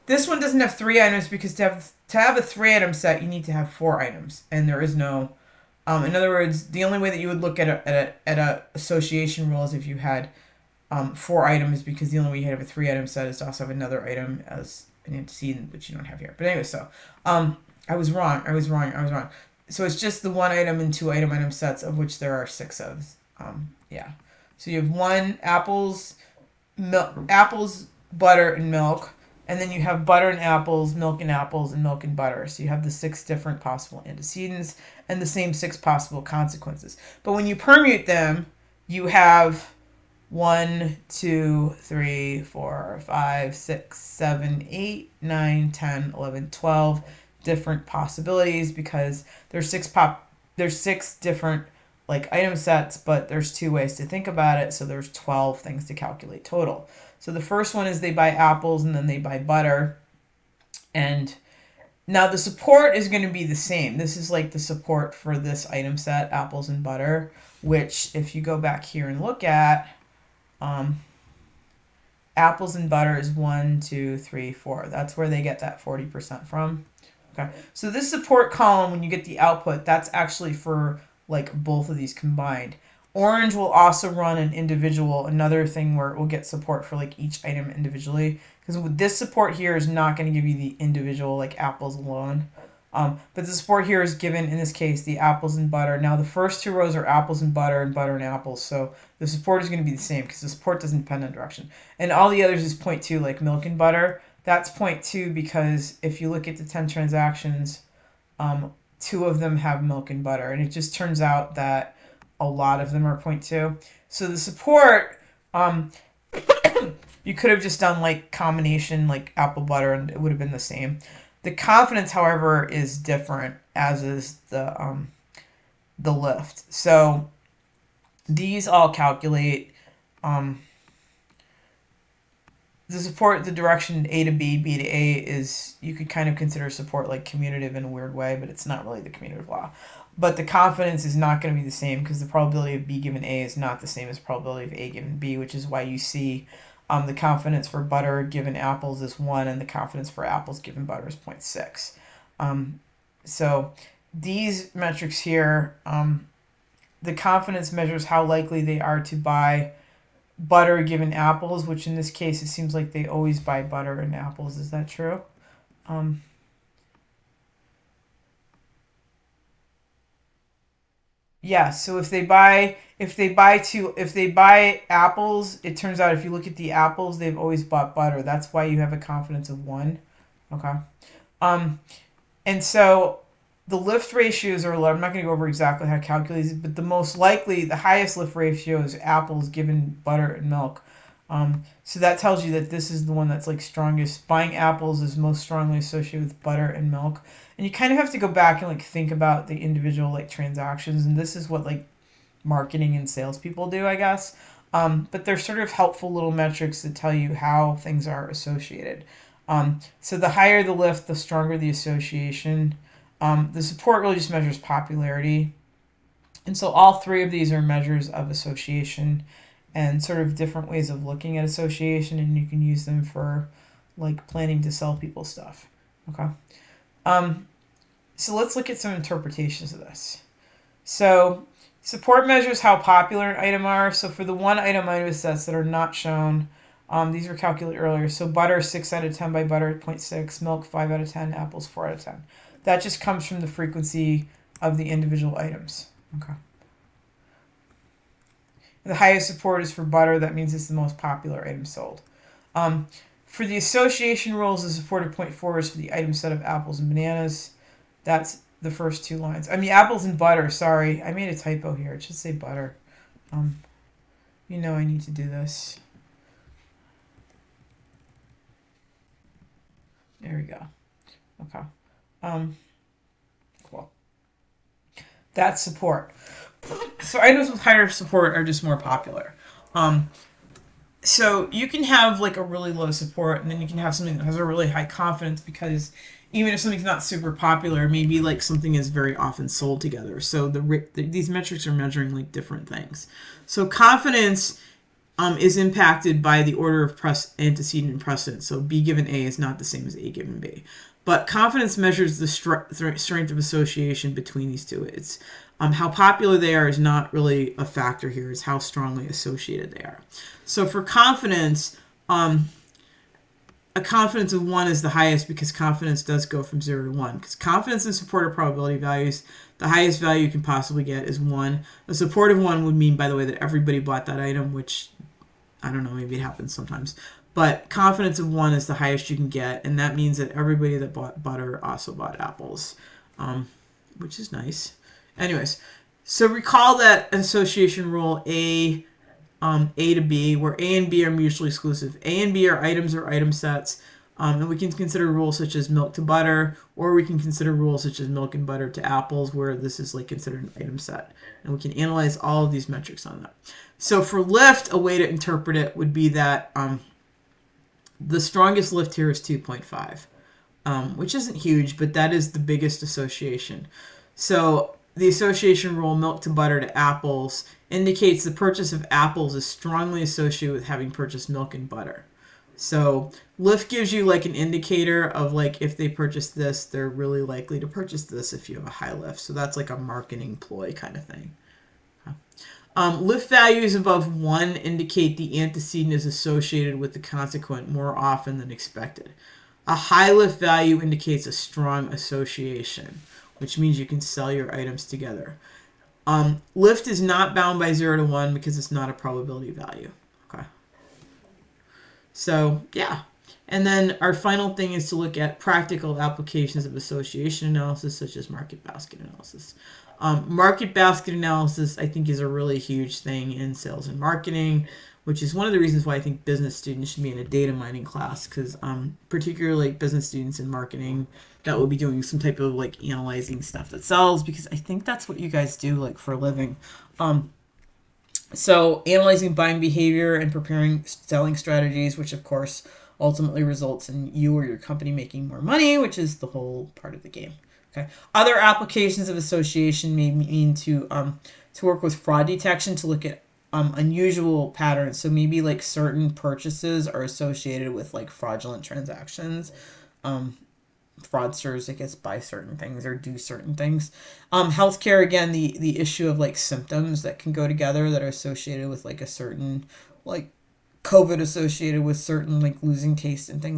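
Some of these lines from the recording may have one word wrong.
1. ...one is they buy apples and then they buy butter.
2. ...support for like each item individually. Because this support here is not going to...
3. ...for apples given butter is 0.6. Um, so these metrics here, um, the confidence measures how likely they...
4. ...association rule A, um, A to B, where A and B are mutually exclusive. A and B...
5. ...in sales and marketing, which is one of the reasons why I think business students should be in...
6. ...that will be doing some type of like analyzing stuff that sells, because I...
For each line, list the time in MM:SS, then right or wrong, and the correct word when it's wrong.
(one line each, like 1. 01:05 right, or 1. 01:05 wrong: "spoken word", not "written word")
1. 00:57 right
2. 01:26 right
3. 02:30 right
4. 05:37 right
5. 06:53 right
6. 07:01 right.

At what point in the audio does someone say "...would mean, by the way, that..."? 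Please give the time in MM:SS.
05:22.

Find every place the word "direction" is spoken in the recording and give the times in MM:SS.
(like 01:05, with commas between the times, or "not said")
01:41, 02:13.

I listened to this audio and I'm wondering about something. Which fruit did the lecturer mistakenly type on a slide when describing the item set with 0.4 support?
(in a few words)
bananas.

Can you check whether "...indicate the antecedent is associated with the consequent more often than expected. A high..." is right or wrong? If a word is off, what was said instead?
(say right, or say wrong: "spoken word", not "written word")
right.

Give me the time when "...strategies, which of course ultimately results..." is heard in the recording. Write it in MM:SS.
07:11.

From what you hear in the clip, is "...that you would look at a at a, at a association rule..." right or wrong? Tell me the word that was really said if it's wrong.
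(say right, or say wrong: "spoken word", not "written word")
right.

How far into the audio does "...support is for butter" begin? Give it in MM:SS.
04:09.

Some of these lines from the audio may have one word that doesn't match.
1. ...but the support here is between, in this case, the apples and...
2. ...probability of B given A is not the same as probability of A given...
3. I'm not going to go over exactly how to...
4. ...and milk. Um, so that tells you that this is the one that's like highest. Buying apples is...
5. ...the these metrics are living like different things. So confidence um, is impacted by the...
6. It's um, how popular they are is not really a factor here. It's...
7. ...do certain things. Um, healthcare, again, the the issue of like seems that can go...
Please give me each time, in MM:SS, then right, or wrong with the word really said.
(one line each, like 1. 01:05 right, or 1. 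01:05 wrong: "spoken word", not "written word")
1. 01:33 wrong: "given", not "between"
2. 02:22 right
3. 03:04 right
4. 03:10 wrong: "strongest", not "highest"
5. 04:50 wrong: "measuring", not "living"
6. 05:04 right
7. 07:32 wrong: "symptoms", not "seems".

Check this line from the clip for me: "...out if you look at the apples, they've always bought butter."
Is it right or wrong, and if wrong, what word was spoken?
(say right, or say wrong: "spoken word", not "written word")
right.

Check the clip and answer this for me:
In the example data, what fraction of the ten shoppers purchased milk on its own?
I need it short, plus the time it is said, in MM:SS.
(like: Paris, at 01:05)
5 out of 10, at 04:00.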